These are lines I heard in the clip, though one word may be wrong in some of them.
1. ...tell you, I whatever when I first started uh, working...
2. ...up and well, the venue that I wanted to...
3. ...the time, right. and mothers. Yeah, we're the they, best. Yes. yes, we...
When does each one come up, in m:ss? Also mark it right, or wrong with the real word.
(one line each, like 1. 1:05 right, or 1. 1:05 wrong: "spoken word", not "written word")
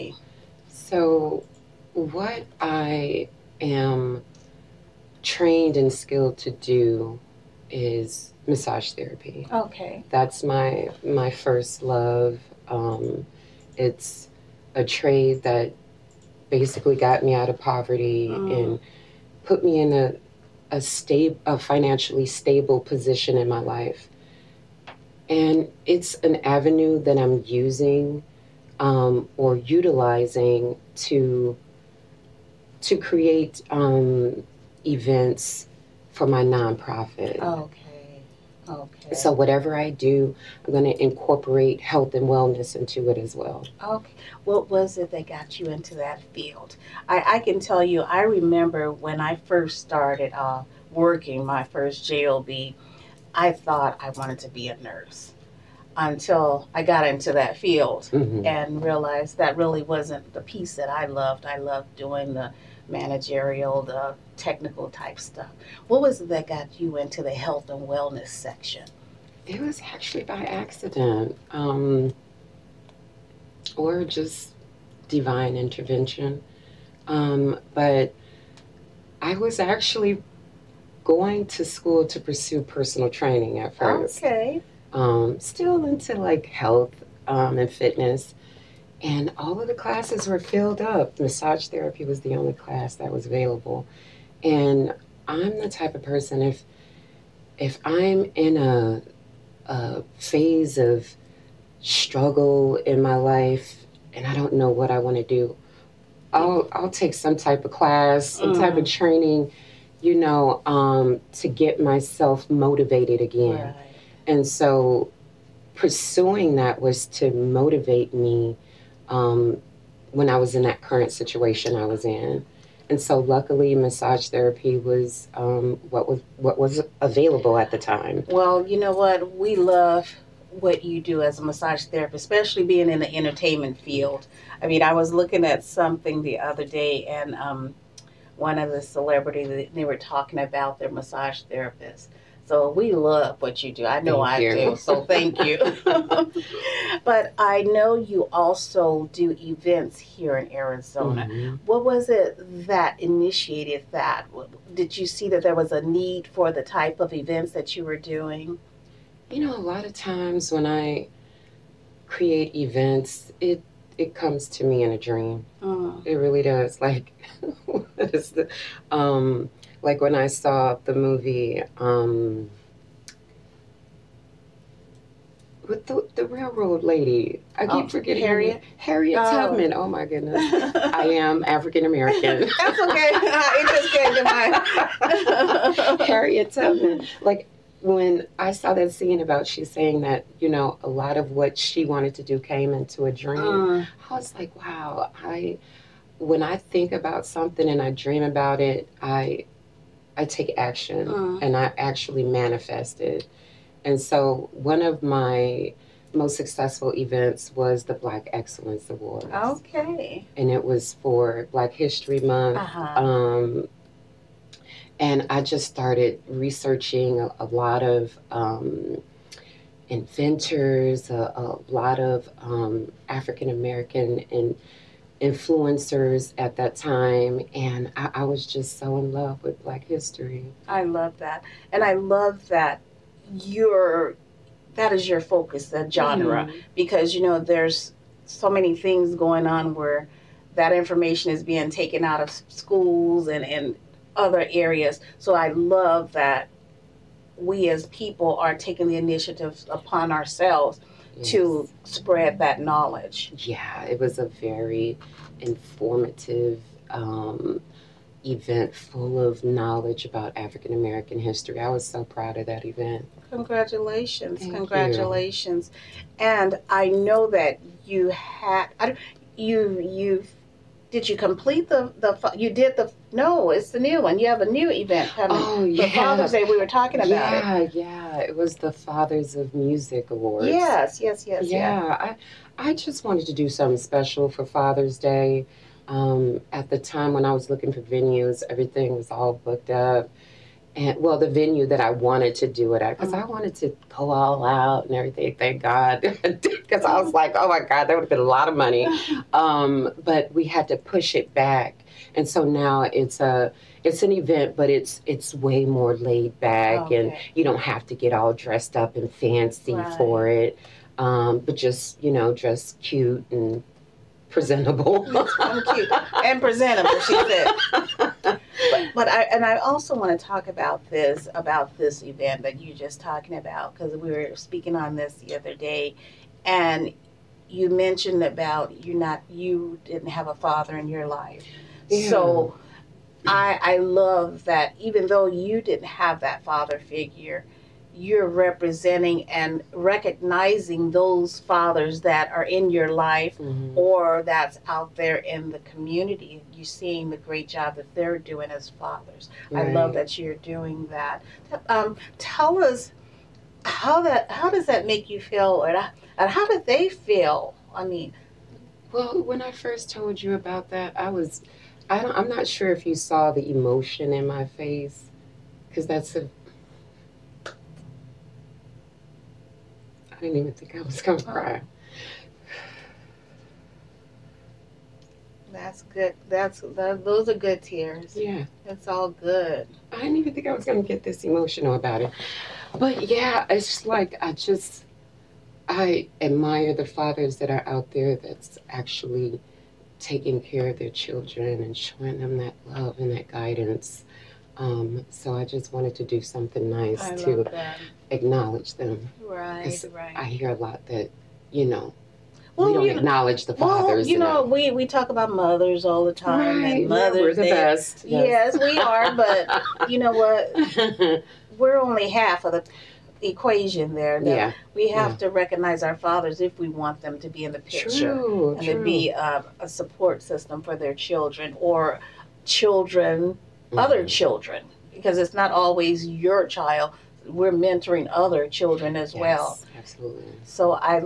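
1. 0:47 wrong: "remember", not "whatever"
2. 4:49 right
3. 6:46 right.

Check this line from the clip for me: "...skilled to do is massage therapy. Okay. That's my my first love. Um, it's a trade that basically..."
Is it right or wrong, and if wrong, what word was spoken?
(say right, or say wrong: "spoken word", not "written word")
right.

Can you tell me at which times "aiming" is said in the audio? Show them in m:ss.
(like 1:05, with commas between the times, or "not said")
not said.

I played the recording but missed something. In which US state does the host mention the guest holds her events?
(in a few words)
Arizona.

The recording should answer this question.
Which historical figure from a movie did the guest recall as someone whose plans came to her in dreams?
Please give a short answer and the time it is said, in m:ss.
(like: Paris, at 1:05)
Harriet Tubman, at 3:06.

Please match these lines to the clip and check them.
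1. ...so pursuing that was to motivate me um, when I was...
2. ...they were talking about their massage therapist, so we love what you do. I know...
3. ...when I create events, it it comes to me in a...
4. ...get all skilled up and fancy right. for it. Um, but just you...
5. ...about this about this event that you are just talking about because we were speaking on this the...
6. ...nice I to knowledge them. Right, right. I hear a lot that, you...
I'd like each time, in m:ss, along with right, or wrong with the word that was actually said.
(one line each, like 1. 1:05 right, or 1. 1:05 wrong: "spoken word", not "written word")
1. 1:54 right
2. 2:19 right
3. 2:40 right
4. 5:07 wrong: "dressed", not "skilled"
5. 5:20 right
6. 6:36 wrong: "acknowledge", not "knowledge".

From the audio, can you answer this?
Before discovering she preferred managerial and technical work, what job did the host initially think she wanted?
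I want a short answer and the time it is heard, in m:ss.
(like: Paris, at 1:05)
Nurse, at 0:54.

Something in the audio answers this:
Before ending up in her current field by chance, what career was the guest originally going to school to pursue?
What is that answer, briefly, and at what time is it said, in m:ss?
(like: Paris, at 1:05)
Personal training, at 1:22.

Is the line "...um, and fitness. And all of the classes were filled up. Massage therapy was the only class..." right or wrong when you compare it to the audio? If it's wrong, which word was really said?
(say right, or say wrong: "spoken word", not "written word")
right.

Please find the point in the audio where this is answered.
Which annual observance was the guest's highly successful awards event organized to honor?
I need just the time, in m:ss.
3:31.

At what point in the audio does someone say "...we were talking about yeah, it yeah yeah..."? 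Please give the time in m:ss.
4:36.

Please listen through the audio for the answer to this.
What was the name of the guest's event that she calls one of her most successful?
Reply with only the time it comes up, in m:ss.
3:27.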